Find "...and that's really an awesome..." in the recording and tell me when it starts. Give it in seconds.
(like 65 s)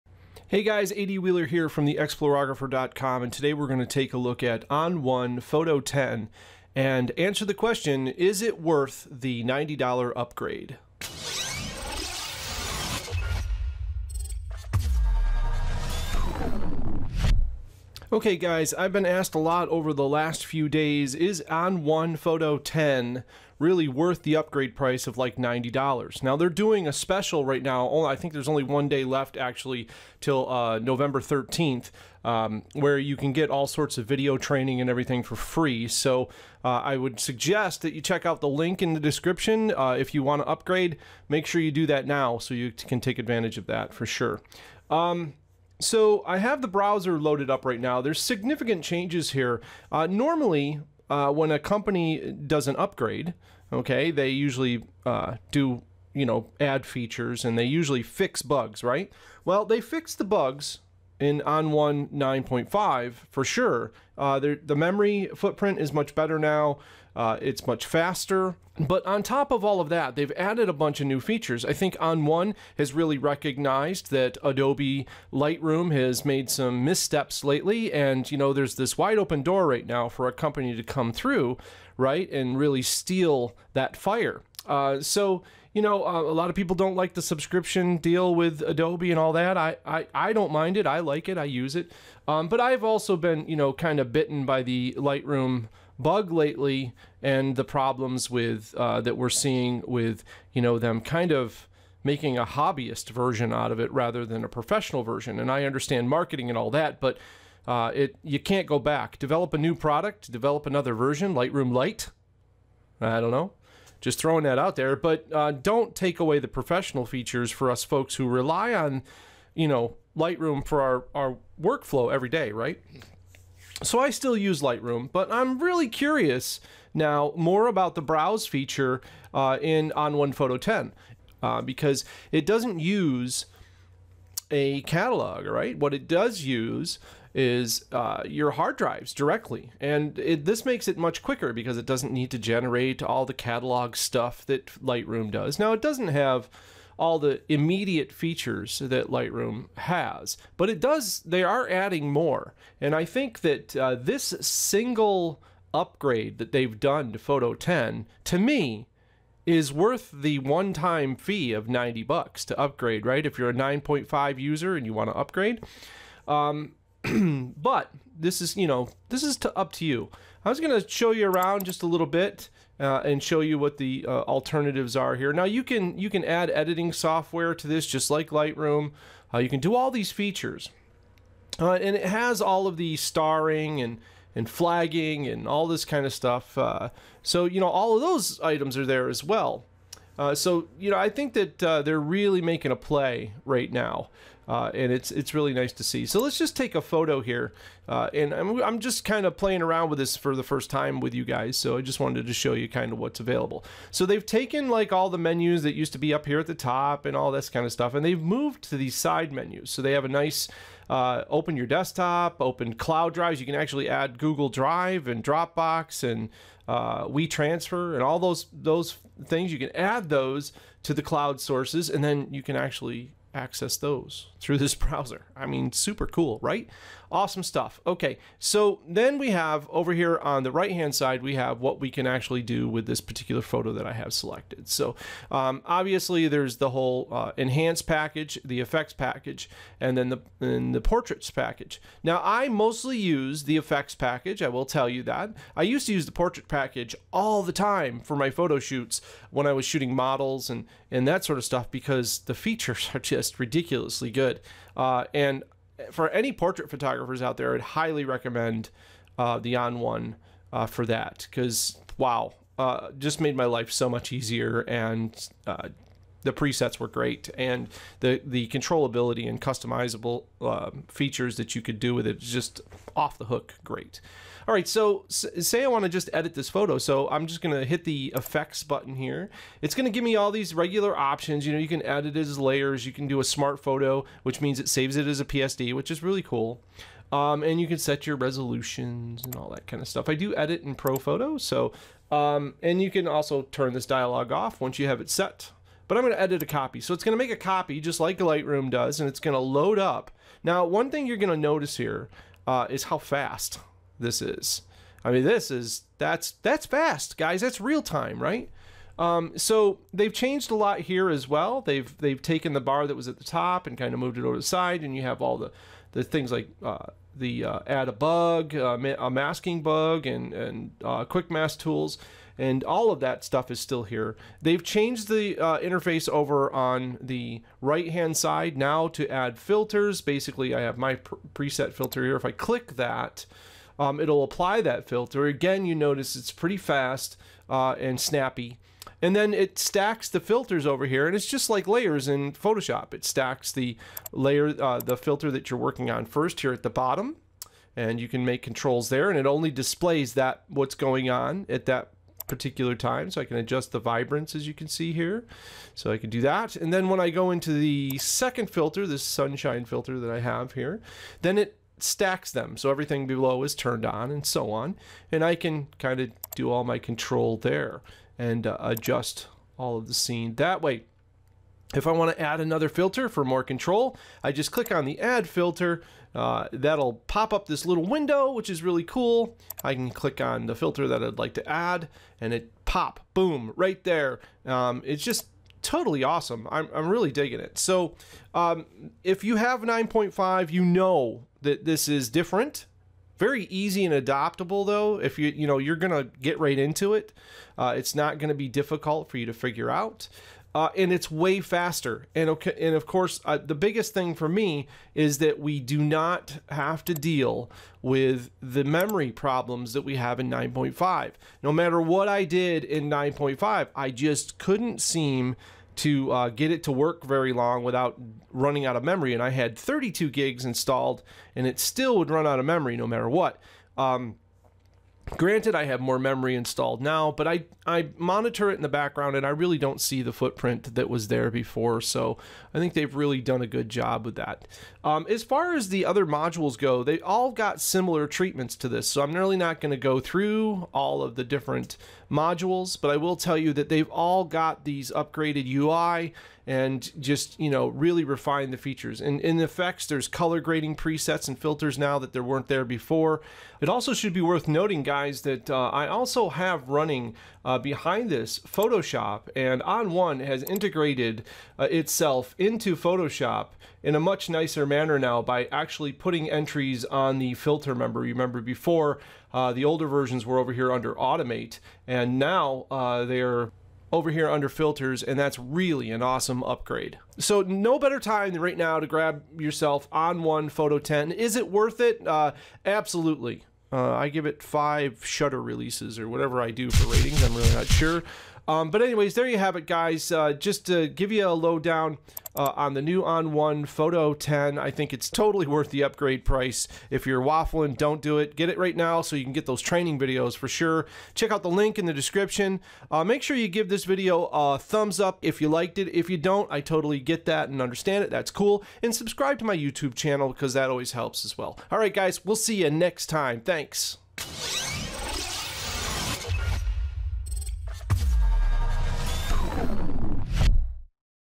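475 s.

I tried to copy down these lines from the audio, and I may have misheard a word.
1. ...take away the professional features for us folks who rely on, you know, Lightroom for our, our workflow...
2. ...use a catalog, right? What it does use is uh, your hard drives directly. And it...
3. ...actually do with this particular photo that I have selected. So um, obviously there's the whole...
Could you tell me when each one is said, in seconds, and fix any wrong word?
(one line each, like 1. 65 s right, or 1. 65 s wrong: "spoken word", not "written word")
1. 115 s right
2. 132 s right
3. 232 s right.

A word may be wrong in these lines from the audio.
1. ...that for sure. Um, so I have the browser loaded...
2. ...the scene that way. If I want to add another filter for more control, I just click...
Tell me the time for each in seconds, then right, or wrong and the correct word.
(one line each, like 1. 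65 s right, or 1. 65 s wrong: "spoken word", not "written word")
1. 43 s right
2. 369 s right.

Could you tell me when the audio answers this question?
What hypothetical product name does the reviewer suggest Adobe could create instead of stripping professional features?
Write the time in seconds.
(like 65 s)
111 s.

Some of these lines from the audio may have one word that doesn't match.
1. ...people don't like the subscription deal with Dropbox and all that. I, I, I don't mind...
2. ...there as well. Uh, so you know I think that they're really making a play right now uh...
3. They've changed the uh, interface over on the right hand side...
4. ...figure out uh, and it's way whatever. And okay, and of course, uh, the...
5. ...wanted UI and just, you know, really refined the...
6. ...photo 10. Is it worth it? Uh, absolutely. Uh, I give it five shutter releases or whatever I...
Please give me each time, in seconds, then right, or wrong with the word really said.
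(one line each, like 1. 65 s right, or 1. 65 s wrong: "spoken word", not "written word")
1. 86 s wrong: "Adobe", not "Dropbox"
2. 188 s right
3. 324 s right
4. 399 s wrong: "faster", not "whatever"
5. 444 s wrong: "upgraded", not "wanted"
6. 480 s right.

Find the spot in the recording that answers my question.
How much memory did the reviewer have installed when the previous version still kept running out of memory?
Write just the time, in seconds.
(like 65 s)
419 s.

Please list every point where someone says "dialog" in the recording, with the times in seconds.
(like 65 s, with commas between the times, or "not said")
293 s.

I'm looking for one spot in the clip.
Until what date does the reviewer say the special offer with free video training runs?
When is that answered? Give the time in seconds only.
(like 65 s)
30 s.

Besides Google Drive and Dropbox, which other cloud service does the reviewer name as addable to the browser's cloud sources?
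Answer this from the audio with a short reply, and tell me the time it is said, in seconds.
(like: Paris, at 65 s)
WeTransfer, at 217 s.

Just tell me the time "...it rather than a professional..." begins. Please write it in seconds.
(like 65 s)
103 s.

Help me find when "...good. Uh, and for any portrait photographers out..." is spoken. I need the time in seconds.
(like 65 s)
254 s.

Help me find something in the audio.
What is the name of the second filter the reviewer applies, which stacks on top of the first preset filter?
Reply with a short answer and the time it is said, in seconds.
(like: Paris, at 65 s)
sunshine filter, at 359 s.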